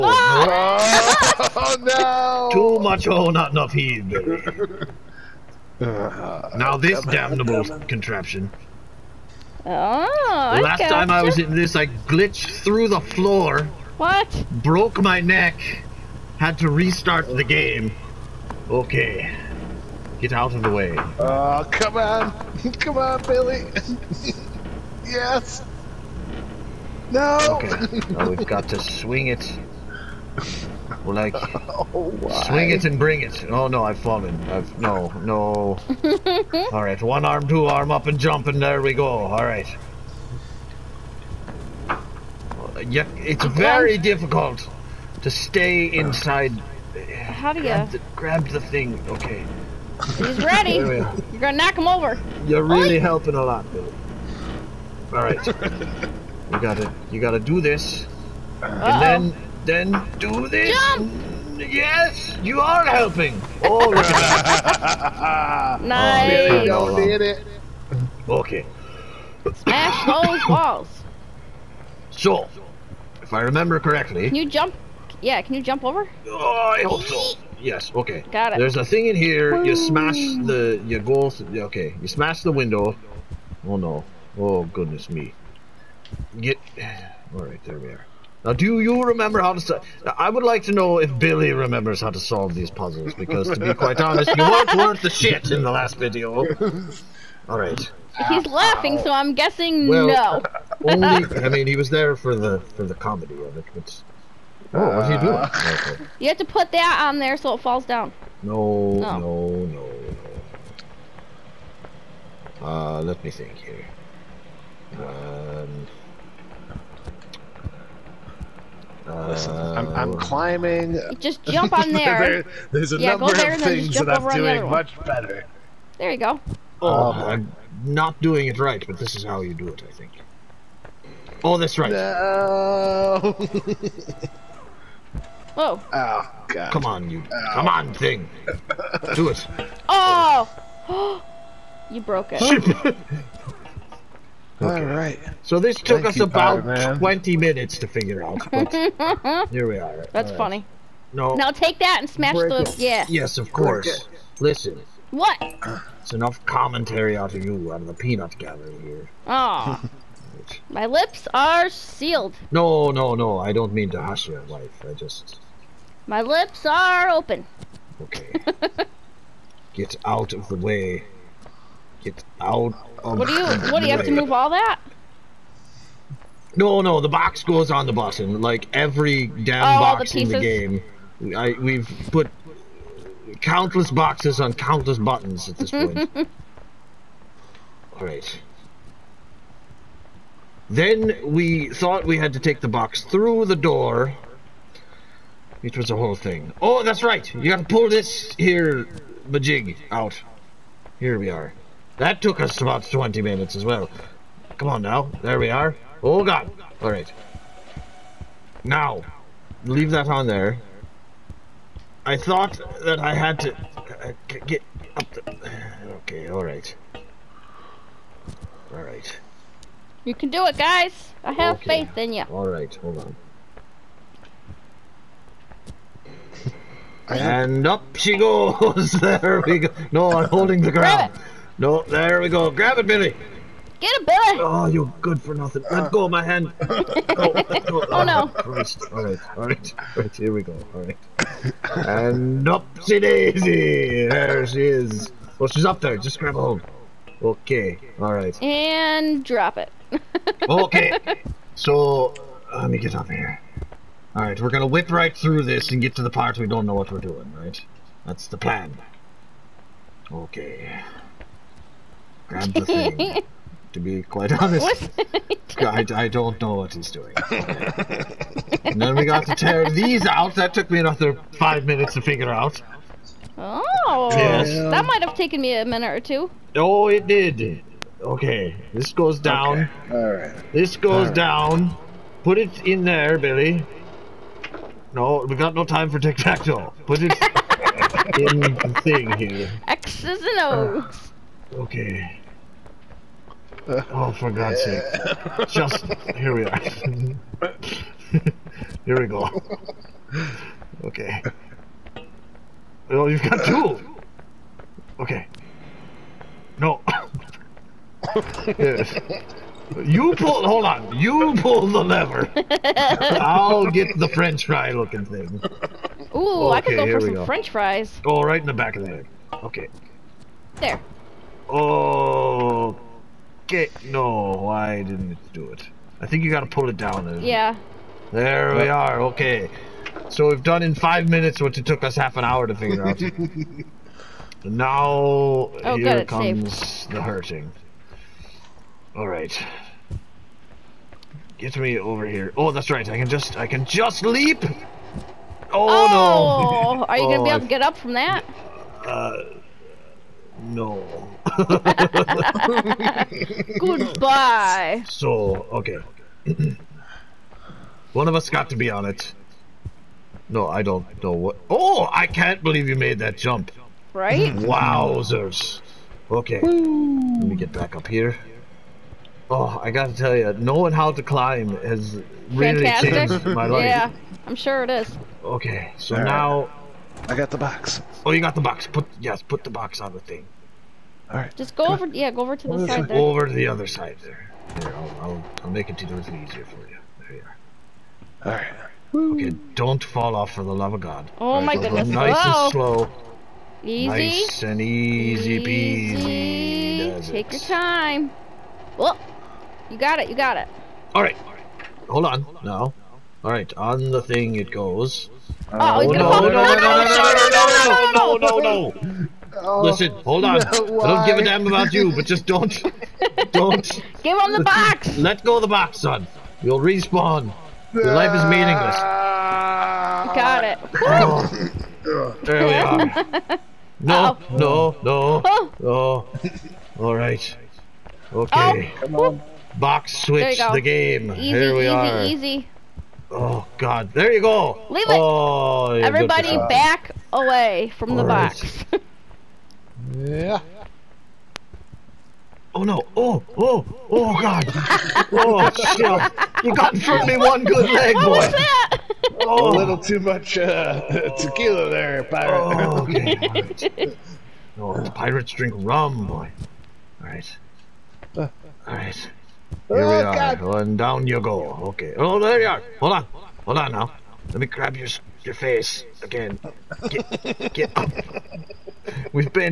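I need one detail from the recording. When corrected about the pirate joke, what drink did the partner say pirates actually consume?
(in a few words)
rum.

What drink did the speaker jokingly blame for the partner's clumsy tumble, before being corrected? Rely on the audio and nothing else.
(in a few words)
tequila.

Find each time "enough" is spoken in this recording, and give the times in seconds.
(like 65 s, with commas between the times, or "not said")
3 s, 156 s.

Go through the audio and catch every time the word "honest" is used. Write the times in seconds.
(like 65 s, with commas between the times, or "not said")
93 s, 264 s.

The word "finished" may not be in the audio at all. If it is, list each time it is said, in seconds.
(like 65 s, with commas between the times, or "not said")
not said.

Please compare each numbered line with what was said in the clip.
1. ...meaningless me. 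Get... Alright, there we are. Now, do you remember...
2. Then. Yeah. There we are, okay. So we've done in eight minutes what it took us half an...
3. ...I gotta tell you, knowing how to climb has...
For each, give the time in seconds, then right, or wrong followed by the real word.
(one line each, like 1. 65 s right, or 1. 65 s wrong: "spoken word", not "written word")
1. 84 s wrong: "goodness", not "meaningless"
2. 327 s wrong: "five", not "eight"
3. 369 s right.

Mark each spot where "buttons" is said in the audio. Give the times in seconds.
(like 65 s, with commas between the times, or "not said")
184 s.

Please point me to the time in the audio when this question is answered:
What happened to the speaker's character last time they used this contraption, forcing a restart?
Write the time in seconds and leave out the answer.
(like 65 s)
14 s.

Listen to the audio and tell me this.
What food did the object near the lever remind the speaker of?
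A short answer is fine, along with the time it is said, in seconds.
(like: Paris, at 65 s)
french fries, at 317 s.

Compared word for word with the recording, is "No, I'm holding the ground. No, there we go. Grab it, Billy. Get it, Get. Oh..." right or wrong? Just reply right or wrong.
wrong.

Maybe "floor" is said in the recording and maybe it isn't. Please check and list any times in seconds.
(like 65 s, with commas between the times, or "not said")
12 s.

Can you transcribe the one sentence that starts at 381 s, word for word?
Yeah, go over to go the side.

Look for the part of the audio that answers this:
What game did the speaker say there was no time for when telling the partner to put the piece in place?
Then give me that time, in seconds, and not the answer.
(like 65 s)
285 s.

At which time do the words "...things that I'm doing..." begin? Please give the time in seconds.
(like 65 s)
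123 s.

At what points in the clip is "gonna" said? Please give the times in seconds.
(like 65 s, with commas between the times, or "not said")
51 s, 254 s, 347 s, 405 s.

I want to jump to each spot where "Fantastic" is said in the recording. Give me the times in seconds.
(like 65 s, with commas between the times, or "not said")
372 s.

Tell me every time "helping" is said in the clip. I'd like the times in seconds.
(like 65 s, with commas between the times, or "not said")
52 s, 62 s.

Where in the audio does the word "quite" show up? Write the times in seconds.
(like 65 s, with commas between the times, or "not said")
93 s, 264 s.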